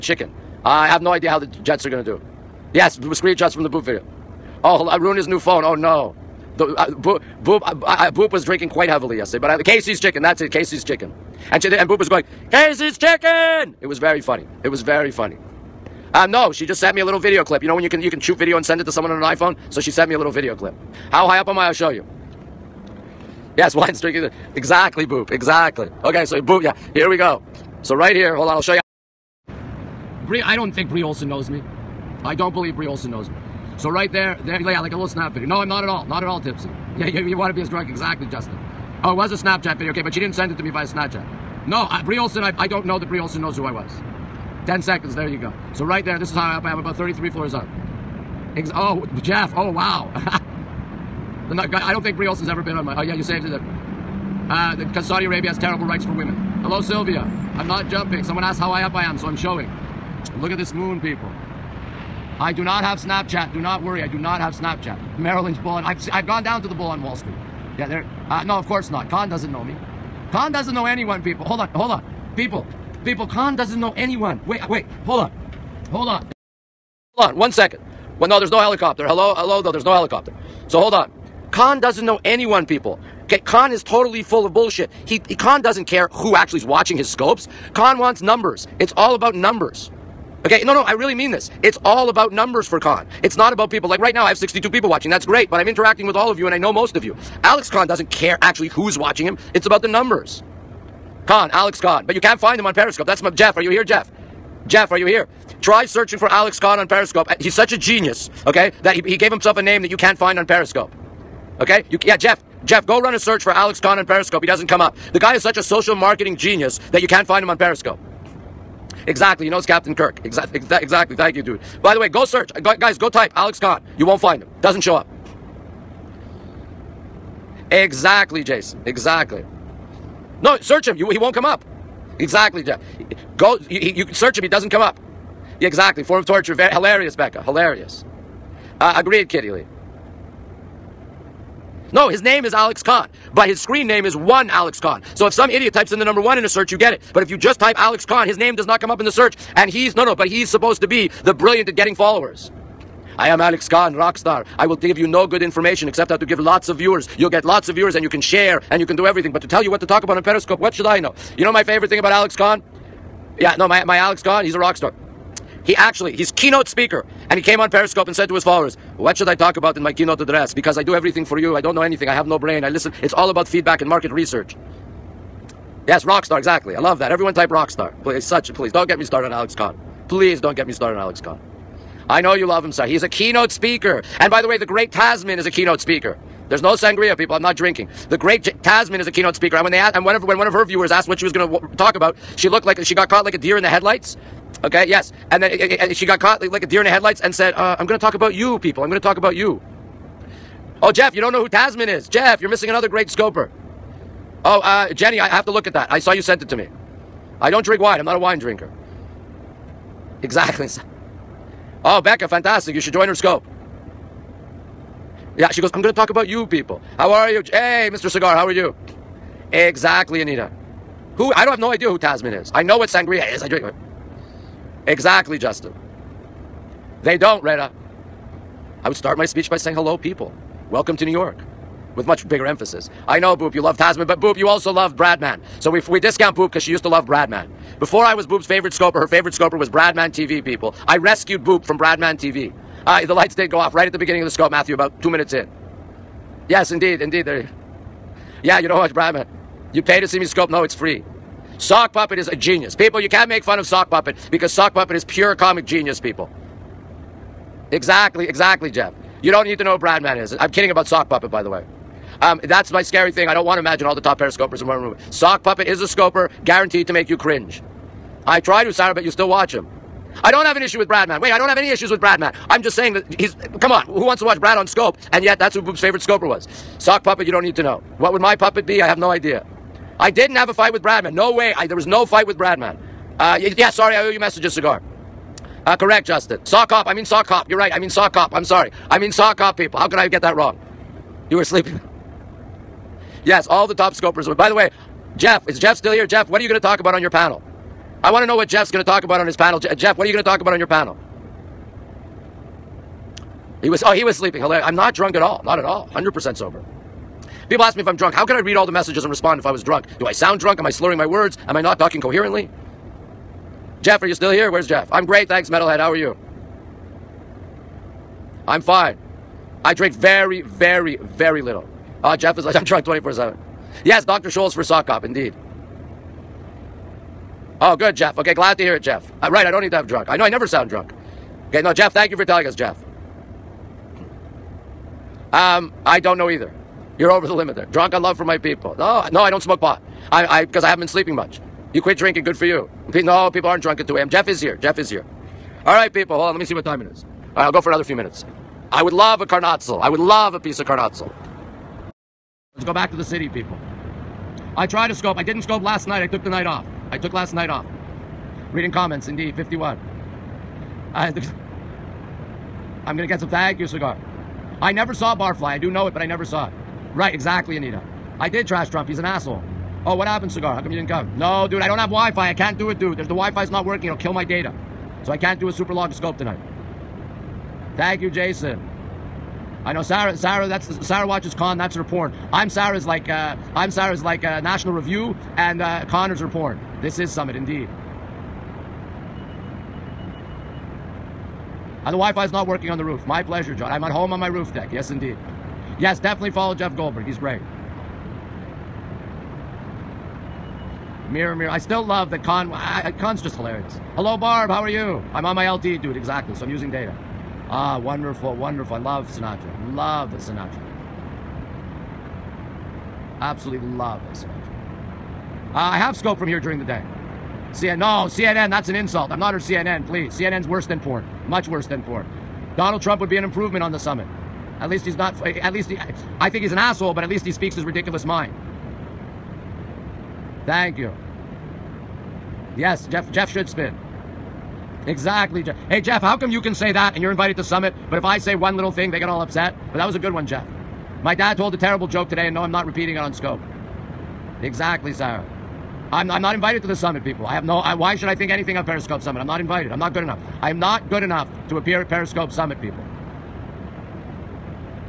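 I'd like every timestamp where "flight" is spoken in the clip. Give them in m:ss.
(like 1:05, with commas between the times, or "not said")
not said.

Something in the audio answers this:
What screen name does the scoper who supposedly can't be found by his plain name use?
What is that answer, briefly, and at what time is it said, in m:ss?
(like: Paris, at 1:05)
One Alex Khan, at 2:24.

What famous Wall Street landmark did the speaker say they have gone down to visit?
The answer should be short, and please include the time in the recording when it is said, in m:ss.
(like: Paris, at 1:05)
The bull, at 1:06.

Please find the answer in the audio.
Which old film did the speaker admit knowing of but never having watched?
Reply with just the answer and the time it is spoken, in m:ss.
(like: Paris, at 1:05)
Barfly, at 6:05.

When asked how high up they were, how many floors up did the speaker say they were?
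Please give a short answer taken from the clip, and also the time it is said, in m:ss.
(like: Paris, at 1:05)
33, at 0:46.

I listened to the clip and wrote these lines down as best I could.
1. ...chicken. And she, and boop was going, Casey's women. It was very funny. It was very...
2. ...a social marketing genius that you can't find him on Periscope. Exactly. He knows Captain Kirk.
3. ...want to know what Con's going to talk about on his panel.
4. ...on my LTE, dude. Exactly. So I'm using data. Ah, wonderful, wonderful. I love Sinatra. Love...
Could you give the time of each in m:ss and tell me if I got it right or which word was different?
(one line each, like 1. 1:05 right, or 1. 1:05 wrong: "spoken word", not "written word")
1. 0:10 wrong: "chicken", not "women"
2. 1:55 right
3. 4:58 wrong: "Jeff", not "Con"
4. 6:45 right.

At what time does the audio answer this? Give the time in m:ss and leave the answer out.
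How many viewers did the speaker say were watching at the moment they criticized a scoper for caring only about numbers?
1:34.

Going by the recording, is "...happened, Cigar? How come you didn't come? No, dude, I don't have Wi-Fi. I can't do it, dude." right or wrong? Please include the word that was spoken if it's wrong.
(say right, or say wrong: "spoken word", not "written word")
right.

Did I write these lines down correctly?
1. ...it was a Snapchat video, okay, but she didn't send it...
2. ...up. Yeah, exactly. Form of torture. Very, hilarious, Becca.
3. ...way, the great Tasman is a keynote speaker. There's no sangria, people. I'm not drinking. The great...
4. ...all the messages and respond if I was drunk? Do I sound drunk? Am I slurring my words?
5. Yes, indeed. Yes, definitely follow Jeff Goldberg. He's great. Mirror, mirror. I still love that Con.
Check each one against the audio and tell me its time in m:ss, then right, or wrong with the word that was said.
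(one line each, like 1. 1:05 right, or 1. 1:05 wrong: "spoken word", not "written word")
1. 0:39 right
2. 2:14 right
3. 3:04 right
4. 5:08 right
5. 6:34 right.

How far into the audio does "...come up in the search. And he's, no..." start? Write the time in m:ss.
2:28.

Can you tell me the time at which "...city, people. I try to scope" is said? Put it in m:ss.
5:53.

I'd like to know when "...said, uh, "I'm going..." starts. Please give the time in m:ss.
3:17.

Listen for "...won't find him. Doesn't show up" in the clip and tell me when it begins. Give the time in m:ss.
2:04.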